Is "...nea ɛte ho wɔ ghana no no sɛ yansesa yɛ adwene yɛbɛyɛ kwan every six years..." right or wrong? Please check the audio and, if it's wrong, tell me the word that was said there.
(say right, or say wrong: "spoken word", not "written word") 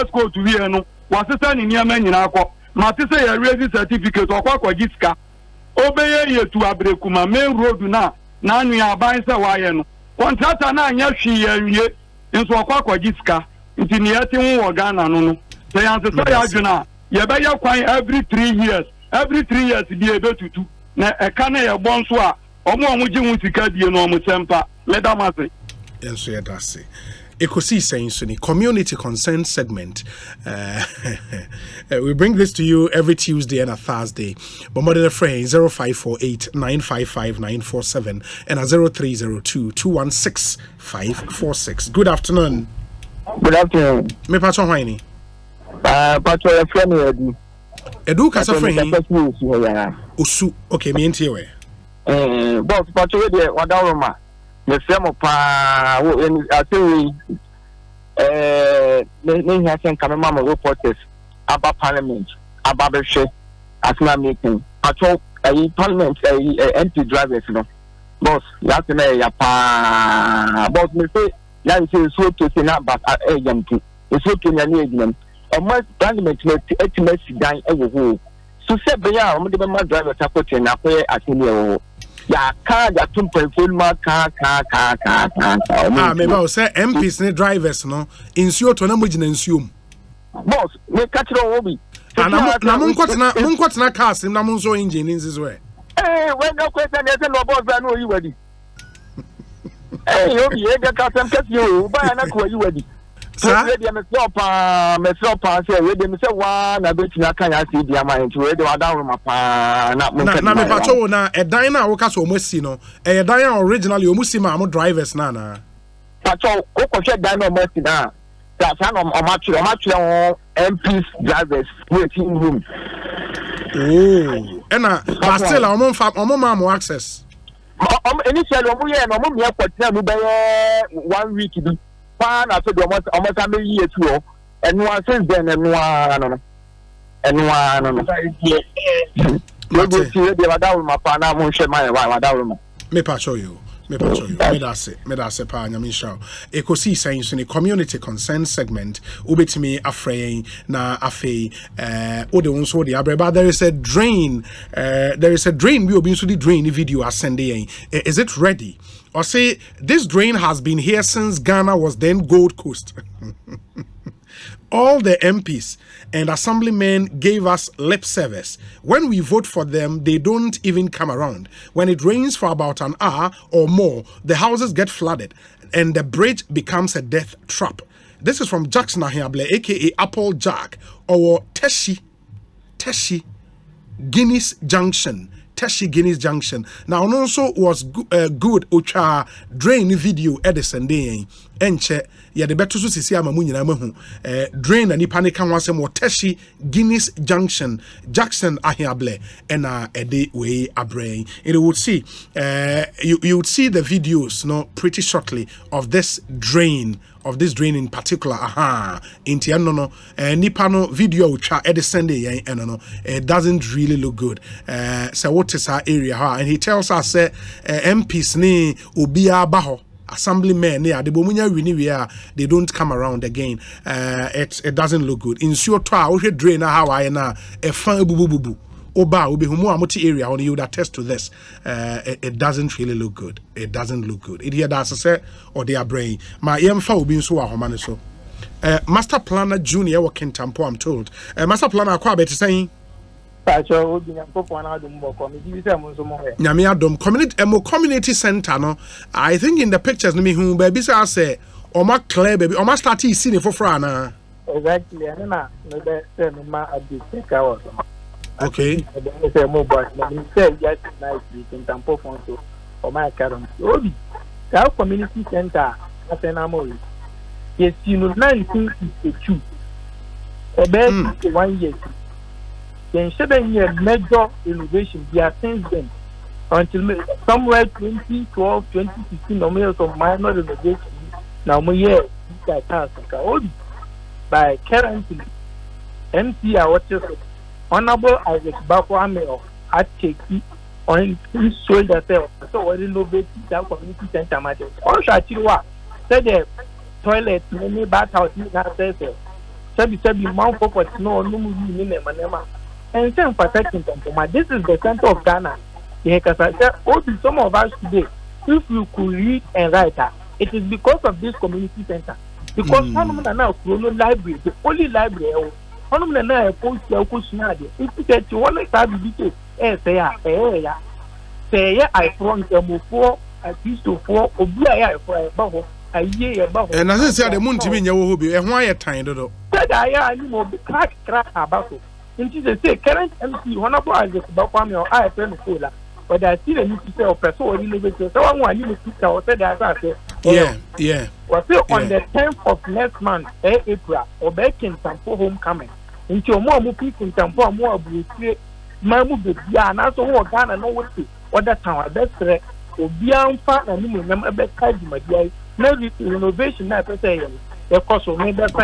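wrong: "three", not "six".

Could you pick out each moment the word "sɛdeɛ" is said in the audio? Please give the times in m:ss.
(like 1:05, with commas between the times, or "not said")
5:29, 5:39.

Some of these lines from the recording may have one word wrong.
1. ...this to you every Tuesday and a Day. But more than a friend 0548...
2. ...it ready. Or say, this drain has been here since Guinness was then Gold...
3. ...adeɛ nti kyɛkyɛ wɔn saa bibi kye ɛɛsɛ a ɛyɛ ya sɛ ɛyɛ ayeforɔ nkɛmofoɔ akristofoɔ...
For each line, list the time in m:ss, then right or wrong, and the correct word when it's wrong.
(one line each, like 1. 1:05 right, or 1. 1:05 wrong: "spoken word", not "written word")
1. 0:32 wrong: "Thursday", not "Day"
2. 2:38 wrong: "Ghana", not "Guinness"
3. 5:17 right.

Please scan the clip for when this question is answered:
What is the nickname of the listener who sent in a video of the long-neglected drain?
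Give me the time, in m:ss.
2:59.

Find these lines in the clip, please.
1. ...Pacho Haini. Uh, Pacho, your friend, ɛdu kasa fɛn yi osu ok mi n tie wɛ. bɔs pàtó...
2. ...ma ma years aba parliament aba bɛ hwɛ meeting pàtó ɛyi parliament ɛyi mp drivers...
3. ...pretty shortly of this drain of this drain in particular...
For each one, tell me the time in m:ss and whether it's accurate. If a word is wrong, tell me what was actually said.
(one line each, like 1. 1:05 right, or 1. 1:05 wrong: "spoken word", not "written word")
1. 0:44 right
2. 1:00 wrong: "reporters", not "years"
3. 3:24 right.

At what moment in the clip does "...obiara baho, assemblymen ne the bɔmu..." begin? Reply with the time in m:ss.
3:39.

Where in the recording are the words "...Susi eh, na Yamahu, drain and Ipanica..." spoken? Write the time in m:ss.
3:12.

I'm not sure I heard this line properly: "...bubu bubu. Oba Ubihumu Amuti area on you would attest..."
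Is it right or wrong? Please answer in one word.
right.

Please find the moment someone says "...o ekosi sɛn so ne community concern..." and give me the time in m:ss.
2:26.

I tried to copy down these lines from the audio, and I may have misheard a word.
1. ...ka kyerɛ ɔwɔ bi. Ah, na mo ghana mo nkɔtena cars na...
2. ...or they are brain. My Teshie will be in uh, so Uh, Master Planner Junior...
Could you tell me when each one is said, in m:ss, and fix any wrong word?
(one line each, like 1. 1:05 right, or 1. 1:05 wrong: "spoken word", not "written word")
1. 1:31 wrong: "nkɔtena", not "ghana"
2. 3:55 wrong: "EMFA", not "Teshie".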